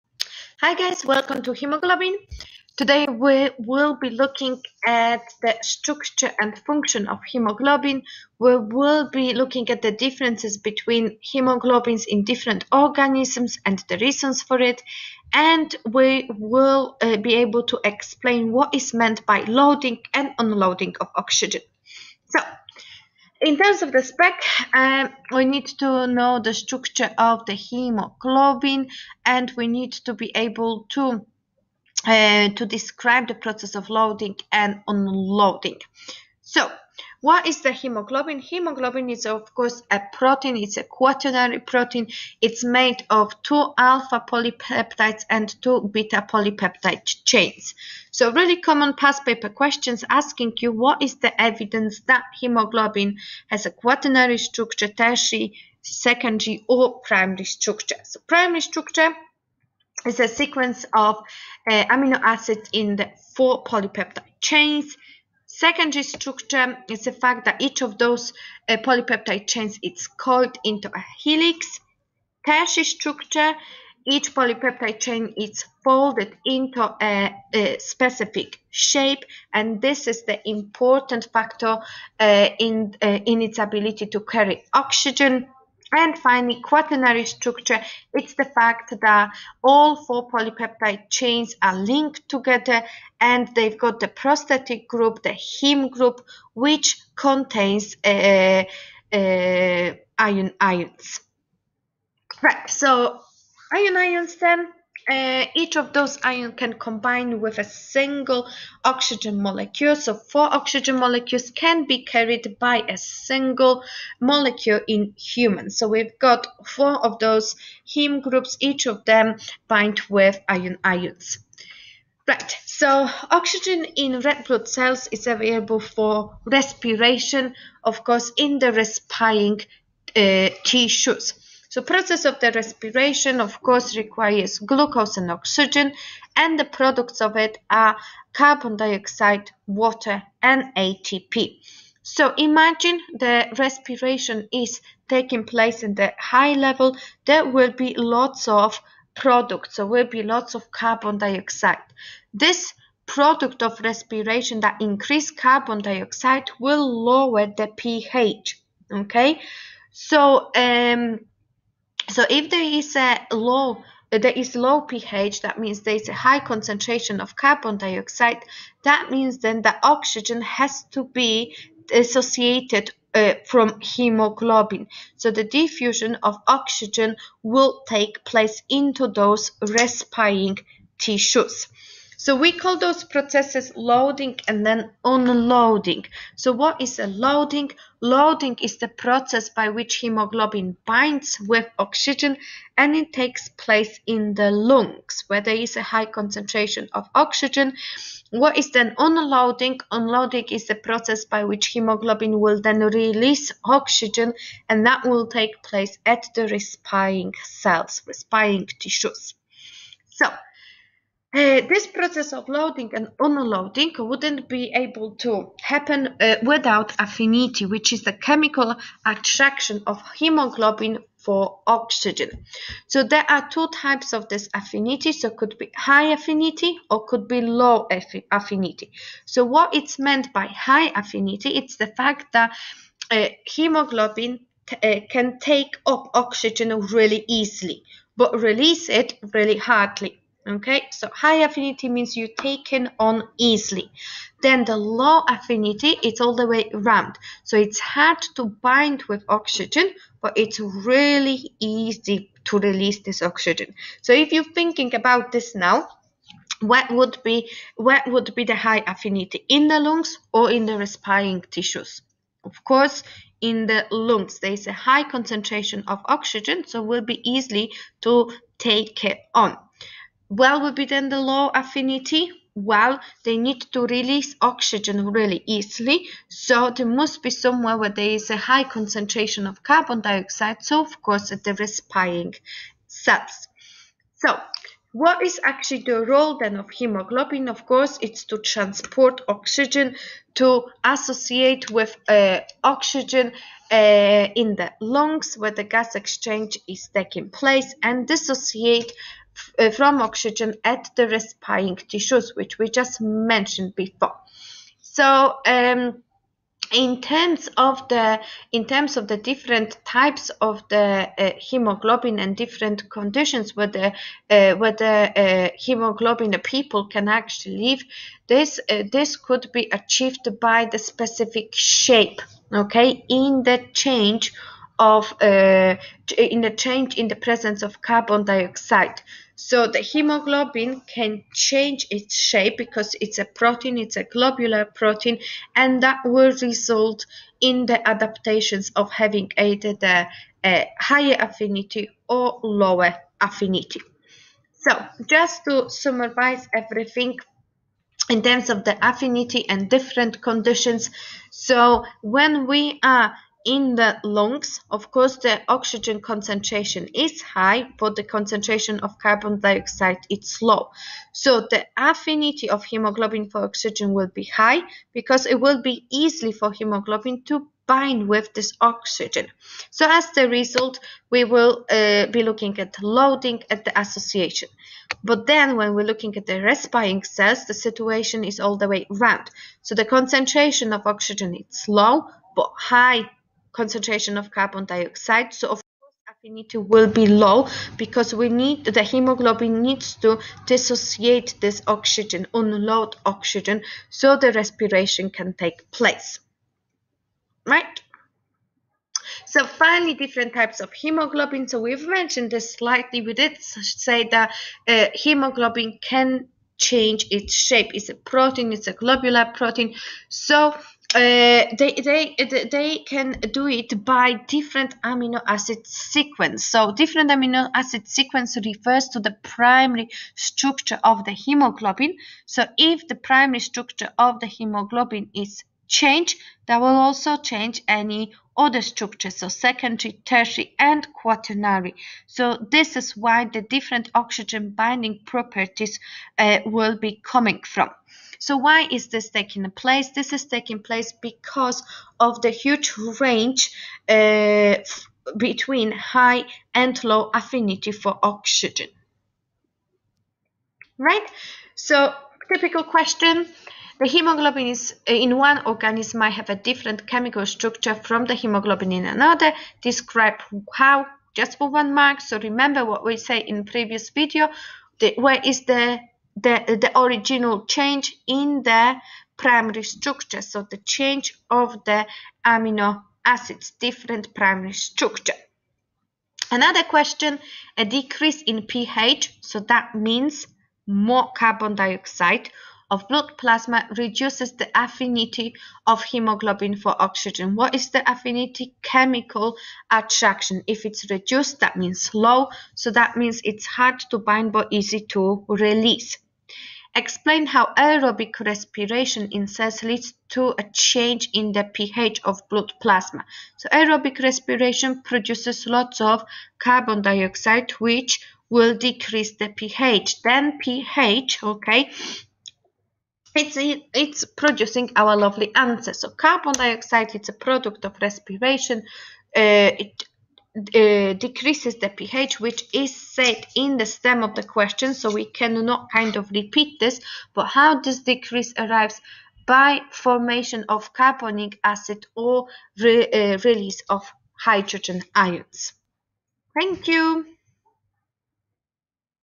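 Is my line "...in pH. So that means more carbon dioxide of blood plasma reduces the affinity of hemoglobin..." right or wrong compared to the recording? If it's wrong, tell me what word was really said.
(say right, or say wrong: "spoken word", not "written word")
right.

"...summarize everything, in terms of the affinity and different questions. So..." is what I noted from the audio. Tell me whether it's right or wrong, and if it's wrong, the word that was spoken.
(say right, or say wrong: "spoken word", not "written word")
wrong: "conditions", not "questions".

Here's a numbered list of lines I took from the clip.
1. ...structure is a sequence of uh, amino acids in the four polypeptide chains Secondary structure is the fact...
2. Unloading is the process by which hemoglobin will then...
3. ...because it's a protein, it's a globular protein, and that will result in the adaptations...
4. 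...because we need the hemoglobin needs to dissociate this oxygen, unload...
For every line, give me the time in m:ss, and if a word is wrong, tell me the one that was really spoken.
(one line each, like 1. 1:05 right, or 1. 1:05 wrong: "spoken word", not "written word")
1. 0:58 right
2. 3:19 right
3. 5:32 right
4. 6:27 right.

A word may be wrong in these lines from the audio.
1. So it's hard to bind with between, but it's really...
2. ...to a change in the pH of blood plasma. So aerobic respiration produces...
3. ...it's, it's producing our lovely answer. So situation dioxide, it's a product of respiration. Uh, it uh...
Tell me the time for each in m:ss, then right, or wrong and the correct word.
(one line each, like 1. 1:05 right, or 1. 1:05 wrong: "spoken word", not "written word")
1. 4:07 wrong: "oxygen", not "between"
2. 8:20 right
3. 8:33 wrong: "carbon", not "situation".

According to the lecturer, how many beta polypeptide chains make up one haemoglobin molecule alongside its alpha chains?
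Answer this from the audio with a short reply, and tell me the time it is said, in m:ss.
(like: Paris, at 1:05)
2, at 0:45.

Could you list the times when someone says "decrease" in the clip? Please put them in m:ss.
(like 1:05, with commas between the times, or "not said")
7:57, 8:28, 8:40, 8:47.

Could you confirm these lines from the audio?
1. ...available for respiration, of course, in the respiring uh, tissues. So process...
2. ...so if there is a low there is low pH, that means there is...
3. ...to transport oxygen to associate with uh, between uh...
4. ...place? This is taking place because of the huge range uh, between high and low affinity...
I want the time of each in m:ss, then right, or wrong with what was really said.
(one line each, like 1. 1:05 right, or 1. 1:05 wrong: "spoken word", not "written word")
1. 2:05 right
2. 2:42 right
3. 4:48 wrong: "oxygen", not "between"
4. 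7:19 right.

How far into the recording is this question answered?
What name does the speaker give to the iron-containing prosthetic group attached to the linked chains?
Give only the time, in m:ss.
1:35.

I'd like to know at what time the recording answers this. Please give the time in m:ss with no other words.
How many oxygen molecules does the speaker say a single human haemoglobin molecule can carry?
1:50.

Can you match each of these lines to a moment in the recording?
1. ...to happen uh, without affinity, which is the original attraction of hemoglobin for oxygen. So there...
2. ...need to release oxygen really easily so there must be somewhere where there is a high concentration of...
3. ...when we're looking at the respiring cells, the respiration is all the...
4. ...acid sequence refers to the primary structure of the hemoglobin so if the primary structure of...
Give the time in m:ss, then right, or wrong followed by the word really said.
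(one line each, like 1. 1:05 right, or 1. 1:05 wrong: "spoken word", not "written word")
1. 3:35 wrong: "chemical", not "original"
2. 4:33 right
3. 6:15 wrong: "situation", not "respiration"
4. 6:57 right.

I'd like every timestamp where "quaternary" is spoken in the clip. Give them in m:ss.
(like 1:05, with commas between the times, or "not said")
0:40, 0:53, 1:26, 7:10.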